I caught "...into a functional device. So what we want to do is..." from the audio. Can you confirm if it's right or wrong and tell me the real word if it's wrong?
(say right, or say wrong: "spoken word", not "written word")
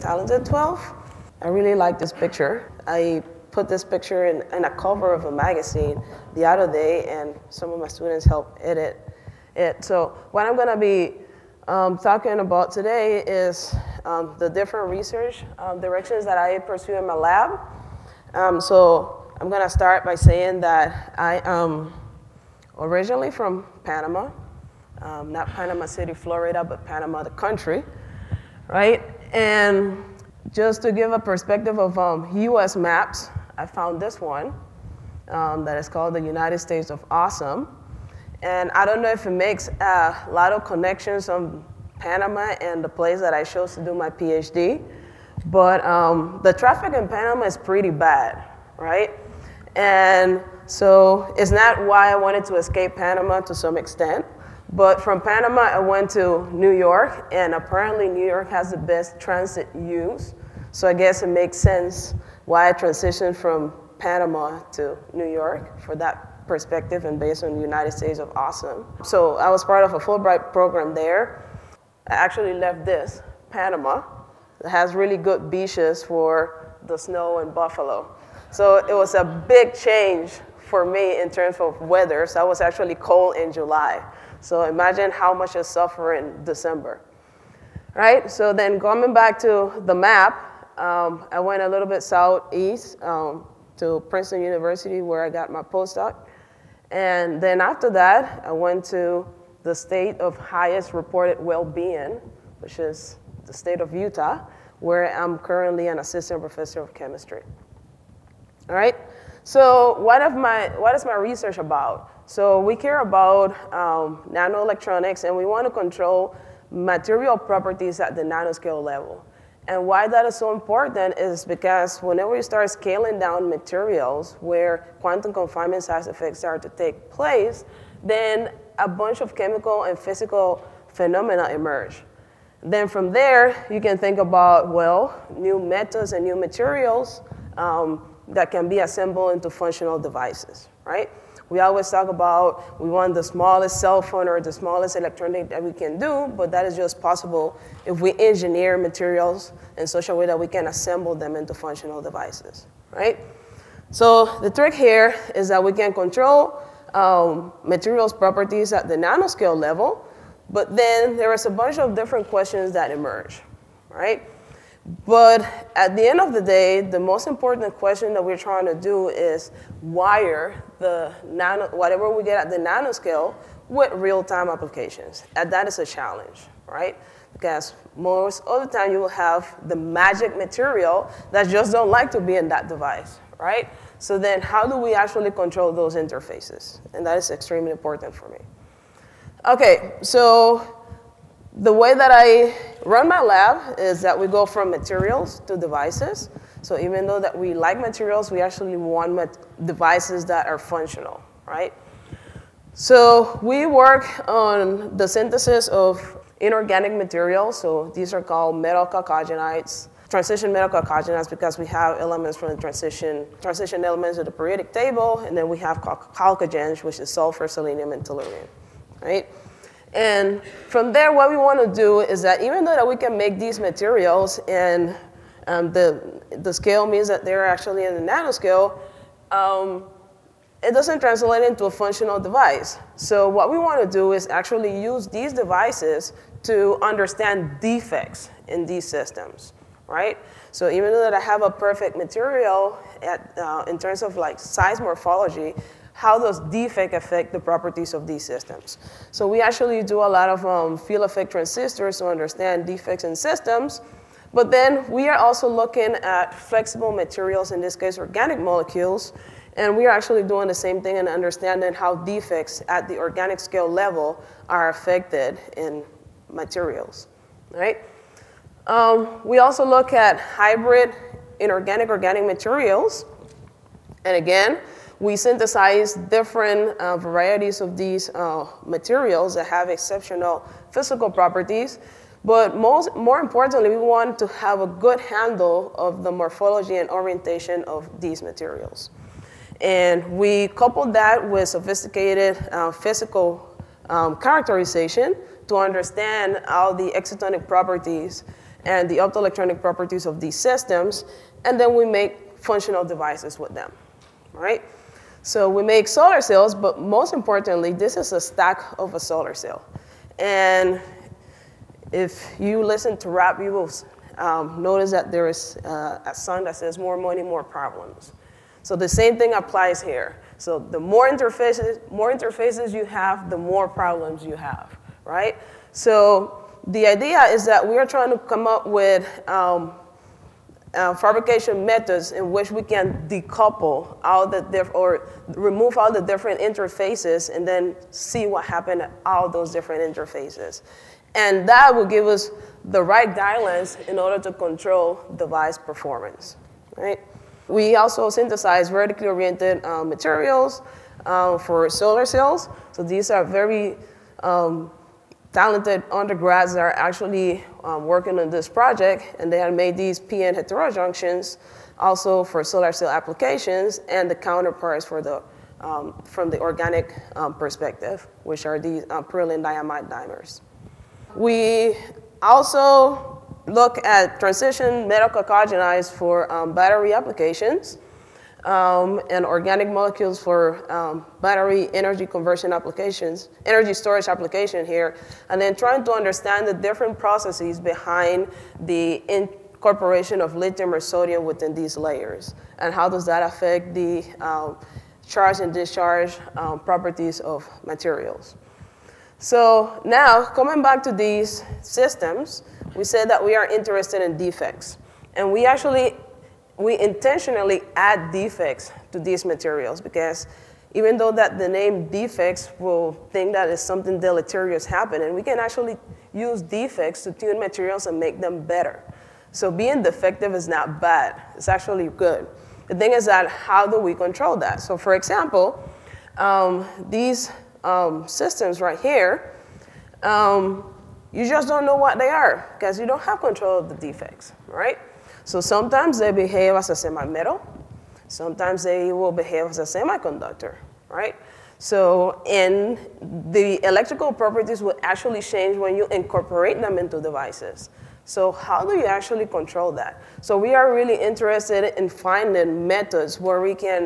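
right.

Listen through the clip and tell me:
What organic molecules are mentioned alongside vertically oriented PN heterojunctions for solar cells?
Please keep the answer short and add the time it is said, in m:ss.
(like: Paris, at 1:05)
perylene diimide dimers, at 6:09.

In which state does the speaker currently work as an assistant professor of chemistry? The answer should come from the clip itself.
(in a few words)
Utah.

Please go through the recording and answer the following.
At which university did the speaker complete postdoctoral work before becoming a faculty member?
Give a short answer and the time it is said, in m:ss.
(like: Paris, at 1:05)
Princeton University, at 1:34.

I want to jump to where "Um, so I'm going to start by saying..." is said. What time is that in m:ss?
0:18.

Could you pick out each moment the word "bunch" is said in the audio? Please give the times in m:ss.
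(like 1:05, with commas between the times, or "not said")
2:08, 2:41.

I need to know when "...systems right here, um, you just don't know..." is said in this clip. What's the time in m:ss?
7:08.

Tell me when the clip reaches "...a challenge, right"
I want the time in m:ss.
2:55.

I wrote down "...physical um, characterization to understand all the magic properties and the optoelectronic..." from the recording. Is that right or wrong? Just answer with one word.
wrong.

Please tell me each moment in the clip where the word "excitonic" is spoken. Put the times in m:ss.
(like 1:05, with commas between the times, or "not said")
4:56.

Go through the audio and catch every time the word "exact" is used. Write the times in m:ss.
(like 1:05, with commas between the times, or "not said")
not said.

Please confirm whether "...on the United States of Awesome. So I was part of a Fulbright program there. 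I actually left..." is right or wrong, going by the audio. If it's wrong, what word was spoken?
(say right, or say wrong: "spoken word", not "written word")
right.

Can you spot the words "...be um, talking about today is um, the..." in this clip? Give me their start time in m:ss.
0:10.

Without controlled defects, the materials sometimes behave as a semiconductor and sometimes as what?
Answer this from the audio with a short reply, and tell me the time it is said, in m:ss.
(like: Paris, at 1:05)
semi-metal, at 7:16.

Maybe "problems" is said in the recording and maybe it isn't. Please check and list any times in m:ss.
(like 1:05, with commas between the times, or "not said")
5:17, 5:23.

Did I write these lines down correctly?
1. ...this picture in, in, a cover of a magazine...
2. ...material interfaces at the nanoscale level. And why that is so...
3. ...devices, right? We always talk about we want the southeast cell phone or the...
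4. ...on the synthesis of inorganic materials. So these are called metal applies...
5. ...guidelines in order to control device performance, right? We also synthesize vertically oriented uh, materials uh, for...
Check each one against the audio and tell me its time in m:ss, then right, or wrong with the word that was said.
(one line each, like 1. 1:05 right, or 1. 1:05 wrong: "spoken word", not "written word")
1. 0:03 right
2. 1:56 wrong: "properties", not "interfaces"
3. 2:19 wrong: "smallest", not "southeast"
4. 3:24 wrong: "chalcogenides", not "applies"
5. 5:43 right.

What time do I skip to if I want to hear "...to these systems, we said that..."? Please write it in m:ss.
6:40.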